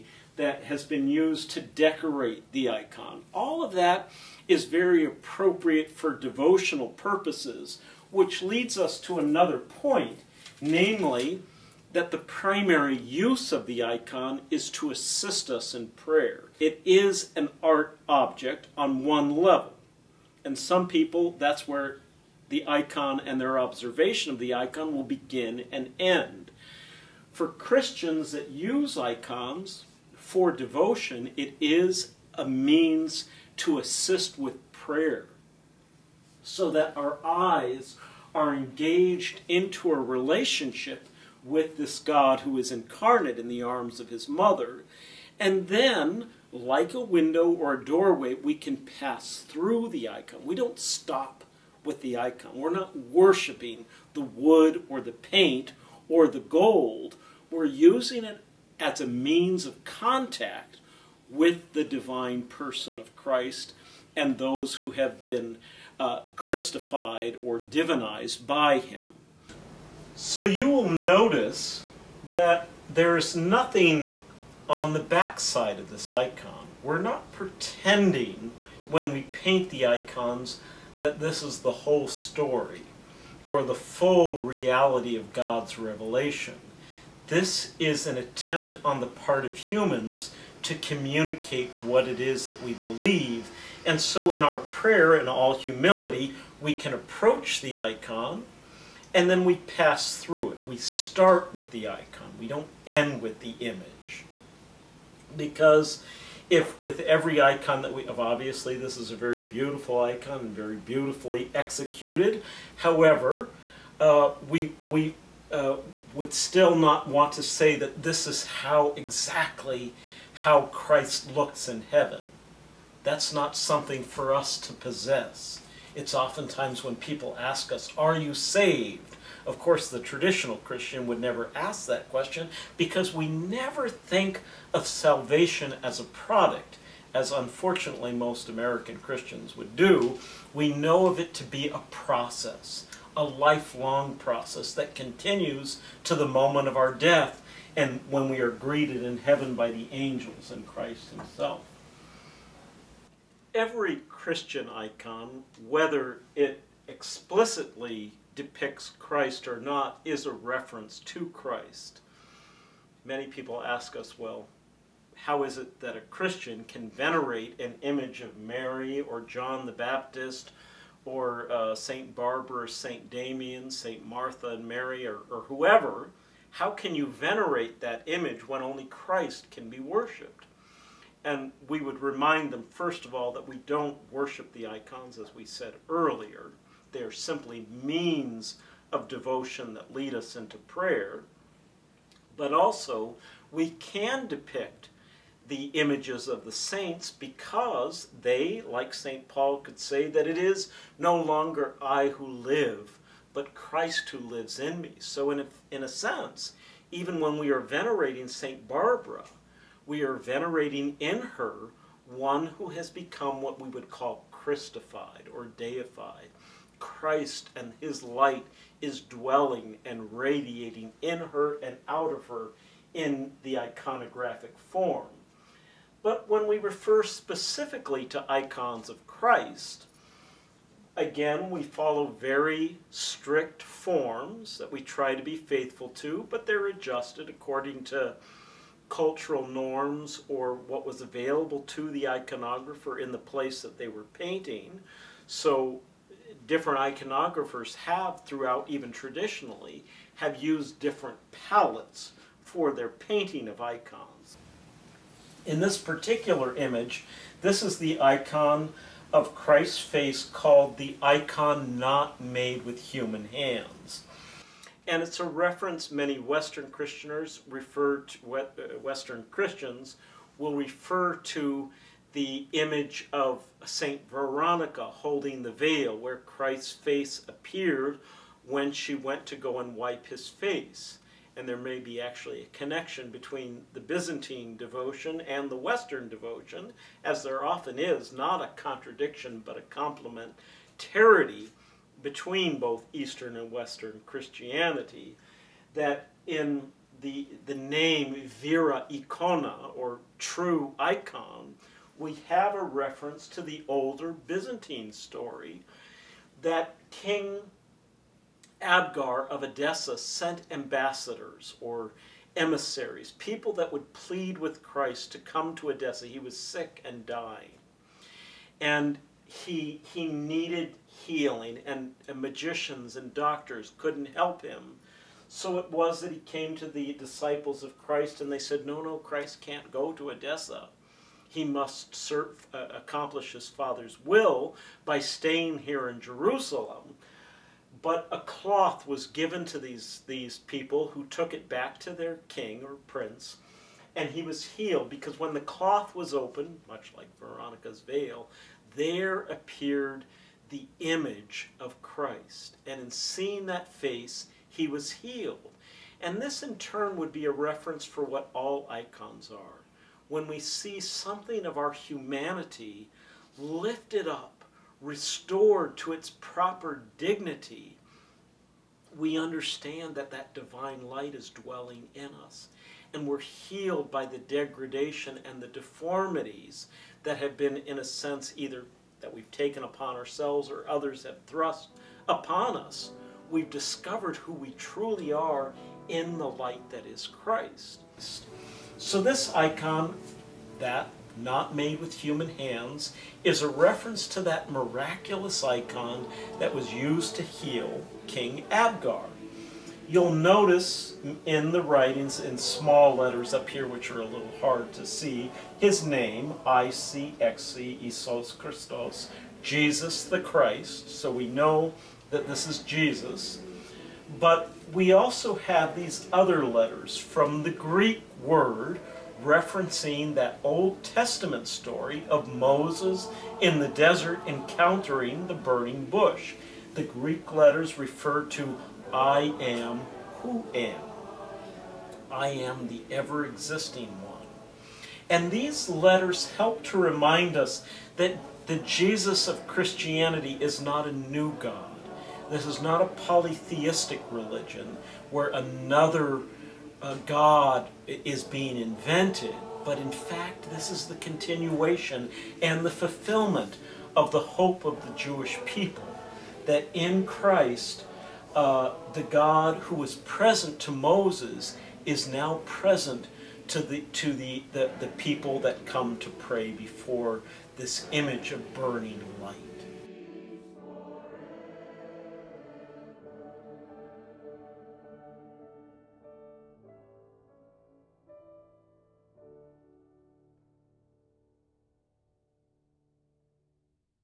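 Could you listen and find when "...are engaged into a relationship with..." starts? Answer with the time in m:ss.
0:38.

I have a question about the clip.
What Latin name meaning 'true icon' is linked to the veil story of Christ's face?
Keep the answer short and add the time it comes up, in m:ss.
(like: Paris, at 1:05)
Vera Icona, at 4:58.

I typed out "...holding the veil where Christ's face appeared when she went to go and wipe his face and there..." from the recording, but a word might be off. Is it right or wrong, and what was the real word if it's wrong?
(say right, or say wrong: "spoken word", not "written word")
right.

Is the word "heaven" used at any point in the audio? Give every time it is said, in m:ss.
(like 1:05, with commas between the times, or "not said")
2:01, 2:29.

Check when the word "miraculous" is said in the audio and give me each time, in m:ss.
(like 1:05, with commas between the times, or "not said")
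6:34.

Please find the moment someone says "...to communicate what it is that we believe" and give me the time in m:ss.
1:30.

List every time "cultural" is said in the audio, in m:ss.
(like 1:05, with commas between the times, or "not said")
3:58.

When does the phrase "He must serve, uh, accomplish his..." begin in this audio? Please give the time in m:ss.
5:31.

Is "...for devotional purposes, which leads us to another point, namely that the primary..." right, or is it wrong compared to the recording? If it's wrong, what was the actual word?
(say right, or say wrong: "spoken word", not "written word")
right.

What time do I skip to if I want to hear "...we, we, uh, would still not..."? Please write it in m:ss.
1:54.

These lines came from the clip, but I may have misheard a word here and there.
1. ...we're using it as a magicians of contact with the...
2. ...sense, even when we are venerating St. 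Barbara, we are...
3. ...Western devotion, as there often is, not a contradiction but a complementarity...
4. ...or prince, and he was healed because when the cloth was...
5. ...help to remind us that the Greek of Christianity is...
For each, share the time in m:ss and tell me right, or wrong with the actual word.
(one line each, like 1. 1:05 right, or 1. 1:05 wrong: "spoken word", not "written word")
1. 0:57 wrong: "means", not "magicians"
2. 3:25 right
3. 4:45 right
4. 5:42 right
5. 7:16 wrong: "Jesus", not "Greek".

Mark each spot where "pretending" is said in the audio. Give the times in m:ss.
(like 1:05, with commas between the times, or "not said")
1:17.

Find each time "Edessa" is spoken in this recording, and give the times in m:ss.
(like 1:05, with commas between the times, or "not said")
5:09, 5:15, 5:30.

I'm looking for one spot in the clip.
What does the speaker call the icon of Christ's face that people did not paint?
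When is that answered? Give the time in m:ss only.
4:21.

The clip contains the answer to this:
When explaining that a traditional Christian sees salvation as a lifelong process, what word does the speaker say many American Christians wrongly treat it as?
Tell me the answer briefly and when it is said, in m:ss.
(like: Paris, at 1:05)
a product, at 2:15.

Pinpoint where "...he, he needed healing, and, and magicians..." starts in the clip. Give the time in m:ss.
5:19.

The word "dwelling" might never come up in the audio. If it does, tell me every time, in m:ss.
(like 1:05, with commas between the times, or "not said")
3:39, 6:11.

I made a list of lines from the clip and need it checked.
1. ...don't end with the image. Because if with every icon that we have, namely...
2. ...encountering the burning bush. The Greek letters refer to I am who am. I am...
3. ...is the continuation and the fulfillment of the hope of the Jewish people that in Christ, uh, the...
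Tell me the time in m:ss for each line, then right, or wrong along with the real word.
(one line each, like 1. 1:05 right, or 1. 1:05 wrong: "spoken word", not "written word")
1. 1:42 wrong: "obviously", not "namely"
2. 7:04 right
3. 7:30 right.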